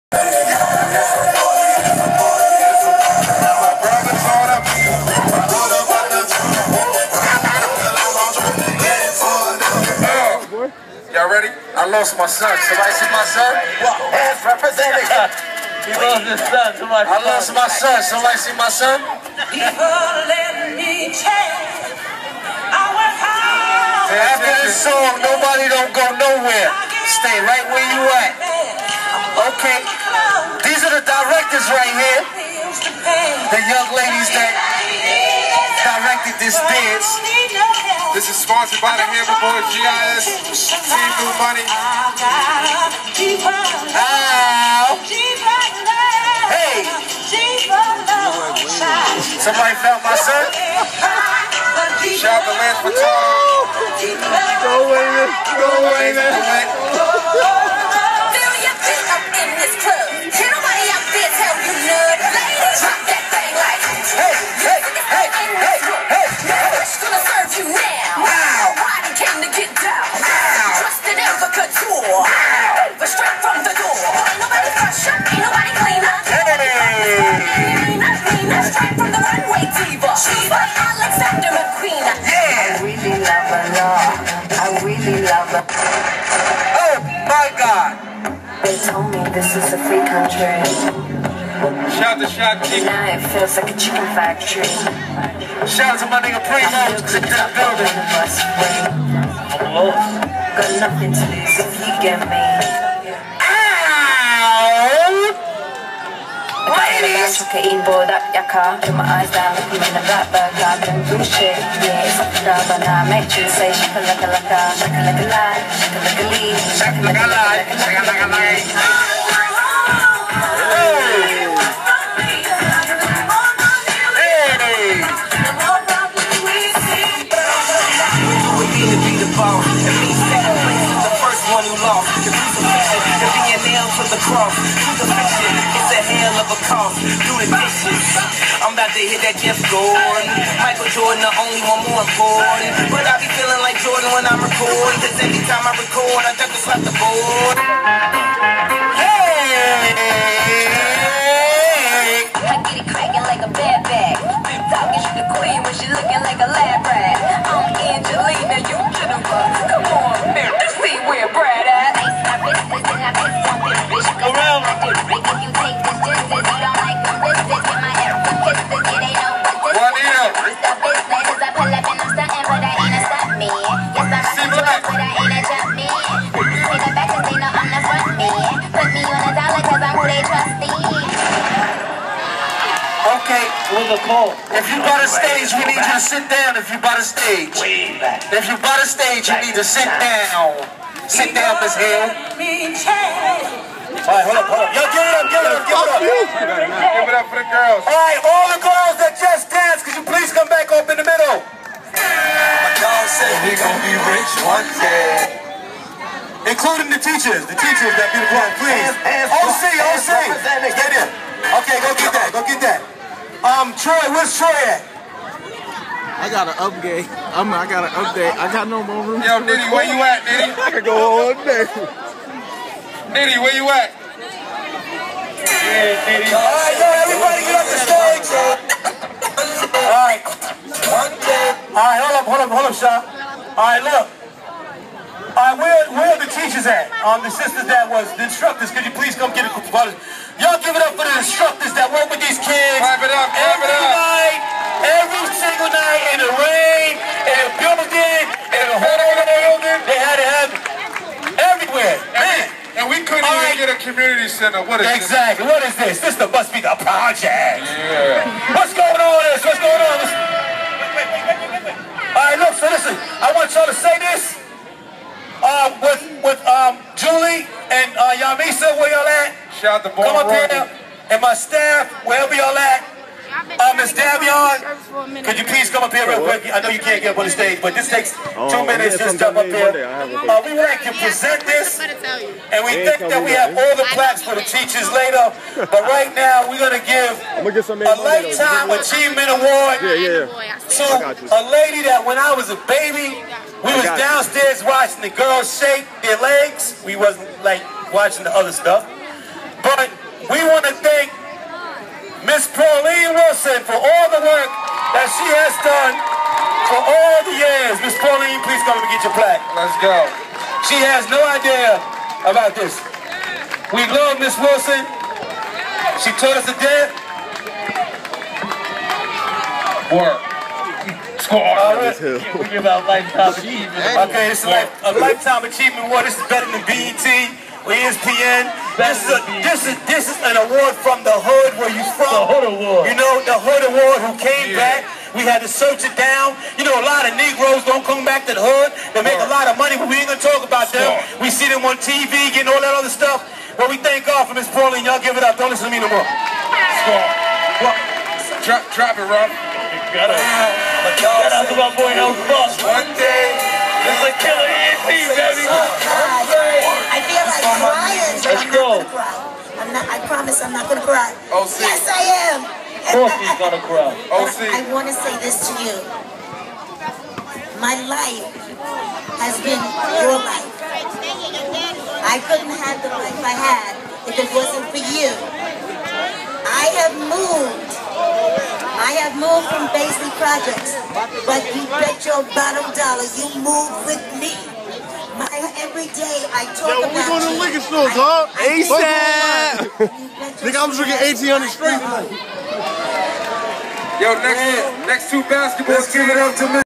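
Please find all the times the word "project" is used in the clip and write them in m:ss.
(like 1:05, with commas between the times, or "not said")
4:16, 6:20.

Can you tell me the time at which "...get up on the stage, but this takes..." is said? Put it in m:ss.
4:37.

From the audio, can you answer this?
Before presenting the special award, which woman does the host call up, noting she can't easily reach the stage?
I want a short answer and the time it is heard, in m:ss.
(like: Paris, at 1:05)
Miss Davion, at 4:33.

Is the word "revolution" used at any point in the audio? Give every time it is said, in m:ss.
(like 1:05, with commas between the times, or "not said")
not said.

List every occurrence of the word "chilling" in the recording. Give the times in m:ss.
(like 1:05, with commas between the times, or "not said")
not said.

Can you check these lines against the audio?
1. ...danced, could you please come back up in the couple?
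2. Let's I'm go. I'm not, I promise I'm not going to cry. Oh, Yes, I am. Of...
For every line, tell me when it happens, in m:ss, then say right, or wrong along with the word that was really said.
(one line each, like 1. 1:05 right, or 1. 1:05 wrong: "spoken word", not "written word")
1. 3:19 wrong: "middle", not "couple"
2. 5:58 right.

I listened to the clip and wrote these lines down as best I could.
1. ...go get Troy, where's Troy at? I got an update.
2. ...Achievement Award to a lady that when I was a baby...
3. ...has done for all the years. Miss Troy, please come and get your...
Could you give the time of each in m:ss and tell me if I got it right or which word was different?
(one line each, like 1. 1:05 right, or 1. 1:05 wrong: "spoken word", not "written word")
1. 3:31 right
2. 4:48 right
3. 5:05 wrong: "Pauline", not "Troy".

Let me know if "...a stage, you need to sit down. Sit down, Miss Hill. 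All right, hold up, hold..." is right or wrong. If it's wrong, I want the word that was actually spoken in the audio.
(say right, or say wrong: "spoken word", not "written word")
right.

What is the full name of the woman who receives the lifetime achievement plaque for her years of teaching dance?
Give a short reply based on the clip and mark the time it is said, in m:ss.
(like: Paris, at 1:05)
Pauline Wilson, at 5:02.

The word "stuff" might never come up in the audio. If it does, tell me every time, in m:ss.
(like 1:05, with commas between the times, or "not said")
4:58, 5:42.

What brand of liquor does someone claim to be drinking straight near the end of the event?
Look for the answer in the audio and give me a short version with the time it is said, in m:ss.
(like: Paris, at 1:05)
1800, at 6:30.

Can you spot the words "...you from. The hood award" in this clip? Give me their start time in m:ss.
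5:31.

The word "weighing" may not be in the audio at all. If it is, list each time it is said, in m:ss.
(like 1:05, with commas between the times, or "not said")
not said.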